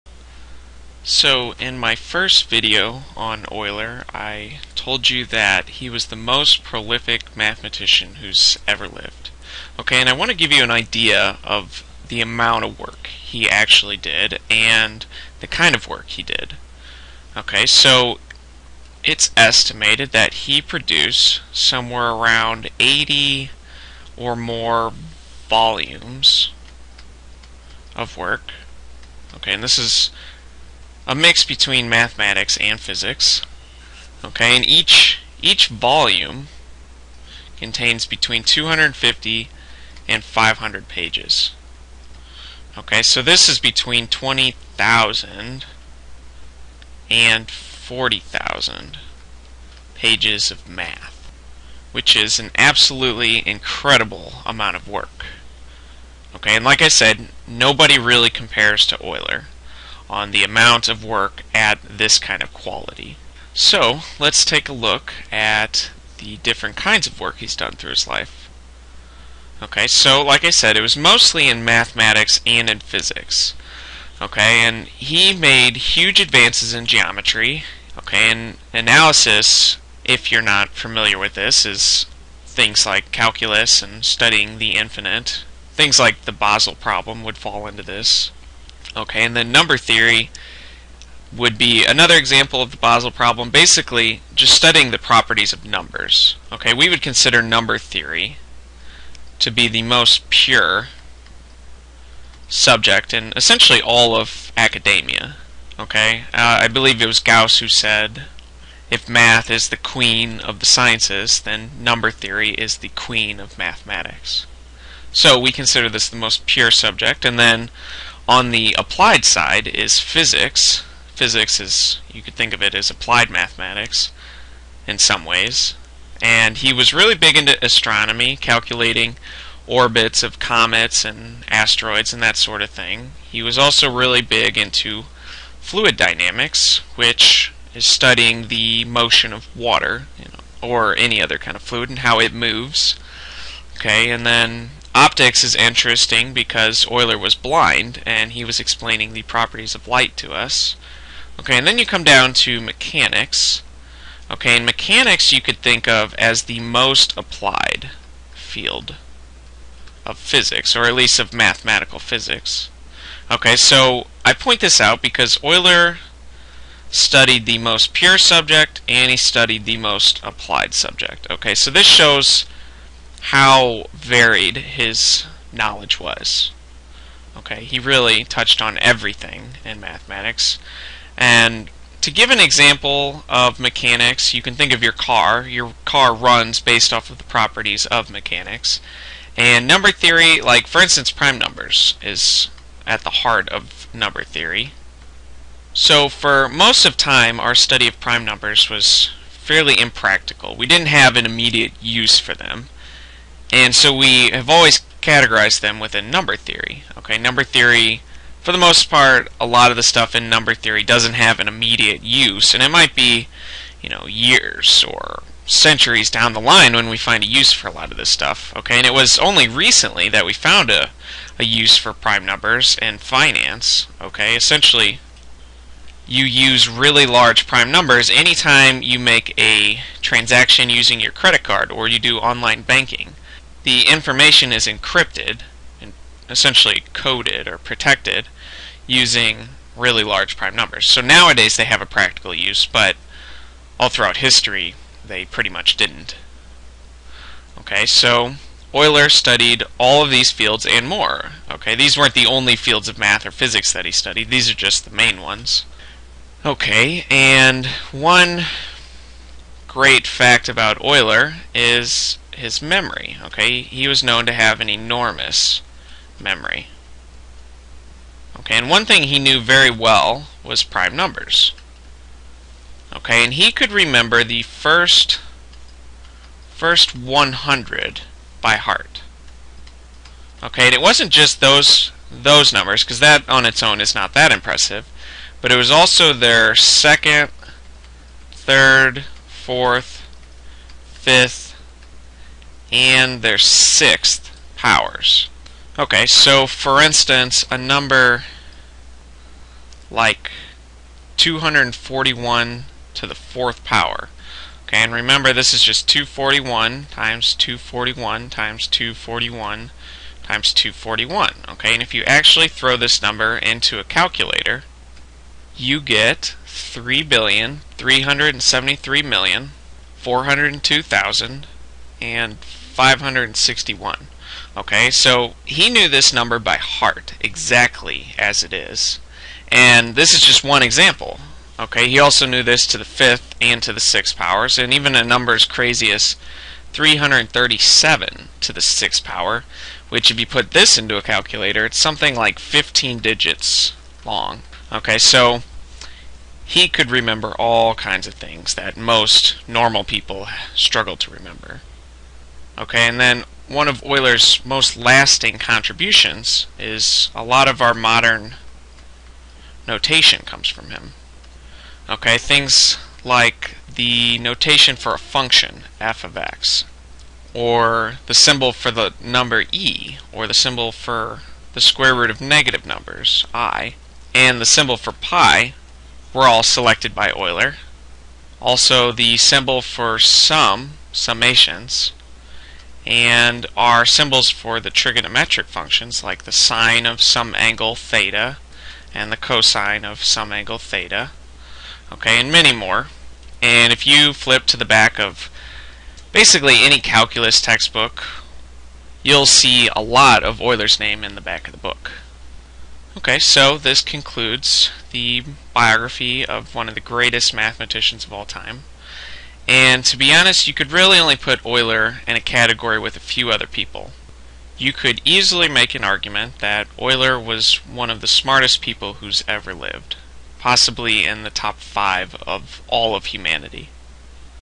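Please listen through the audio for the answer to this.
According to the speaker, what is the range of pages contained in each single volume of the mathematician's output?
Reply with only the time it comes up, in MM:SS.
00:38.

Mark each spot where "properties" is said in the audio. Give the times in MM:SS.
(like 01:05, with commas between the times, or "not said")
01:34, 02:29, 03:07.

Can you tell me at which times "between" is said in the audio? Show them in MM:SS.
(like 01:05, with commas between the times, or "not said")
00:31, 00:38, 00:43.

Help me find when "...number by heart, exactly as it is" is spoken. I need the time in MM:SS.
05:26.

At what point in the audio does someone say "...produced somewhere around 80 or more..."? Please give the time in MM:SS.
00:20.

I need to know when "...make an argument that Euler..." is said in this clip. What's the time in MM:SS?
06:55.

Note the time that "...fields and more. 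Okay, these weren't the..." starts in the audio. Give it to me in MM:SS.
04:10.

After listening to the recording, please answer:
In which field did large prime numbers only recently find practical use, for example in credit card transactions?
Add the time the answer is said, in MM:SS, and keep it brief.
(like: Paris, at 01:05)
Finance, at 03:42.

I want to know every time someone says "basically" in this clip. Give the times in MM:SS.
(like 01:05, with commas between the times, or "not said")
01:33, 06:36.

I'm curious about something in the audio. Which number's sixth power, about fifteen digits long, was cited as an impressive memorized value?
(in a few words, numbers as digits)
337.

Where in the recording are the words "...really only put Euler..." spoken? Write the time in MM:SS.
06:50.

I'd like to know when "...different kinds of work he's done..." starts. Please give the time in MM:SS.
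01:06.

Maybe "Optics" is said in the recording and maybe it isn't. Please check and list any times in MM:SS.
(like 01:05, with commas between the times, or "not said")
02:24.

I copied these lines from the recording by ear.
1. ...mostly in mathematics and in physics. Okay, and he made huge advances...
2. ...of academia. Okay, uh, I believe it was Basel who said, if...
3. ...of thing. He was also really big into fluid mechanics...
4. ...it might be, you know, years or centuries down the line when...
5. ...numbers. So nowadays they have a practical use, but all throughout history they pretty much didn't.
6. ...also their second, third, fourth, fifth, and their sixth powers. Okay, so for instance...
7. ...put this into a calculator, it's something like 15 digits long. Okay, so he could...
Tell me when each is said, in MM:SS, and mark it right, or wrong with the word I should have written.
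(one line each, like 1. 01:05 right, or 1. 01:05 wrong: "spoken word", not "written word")
1. 01:10 right
2. 01:44 wrong: "Gauss", not "Basel"
3. 02:12 wrong: "dynamics", not "mechanics"
4. 03:32 right
5. 04:00 right
6. 04:45 right
7. 05:40 right.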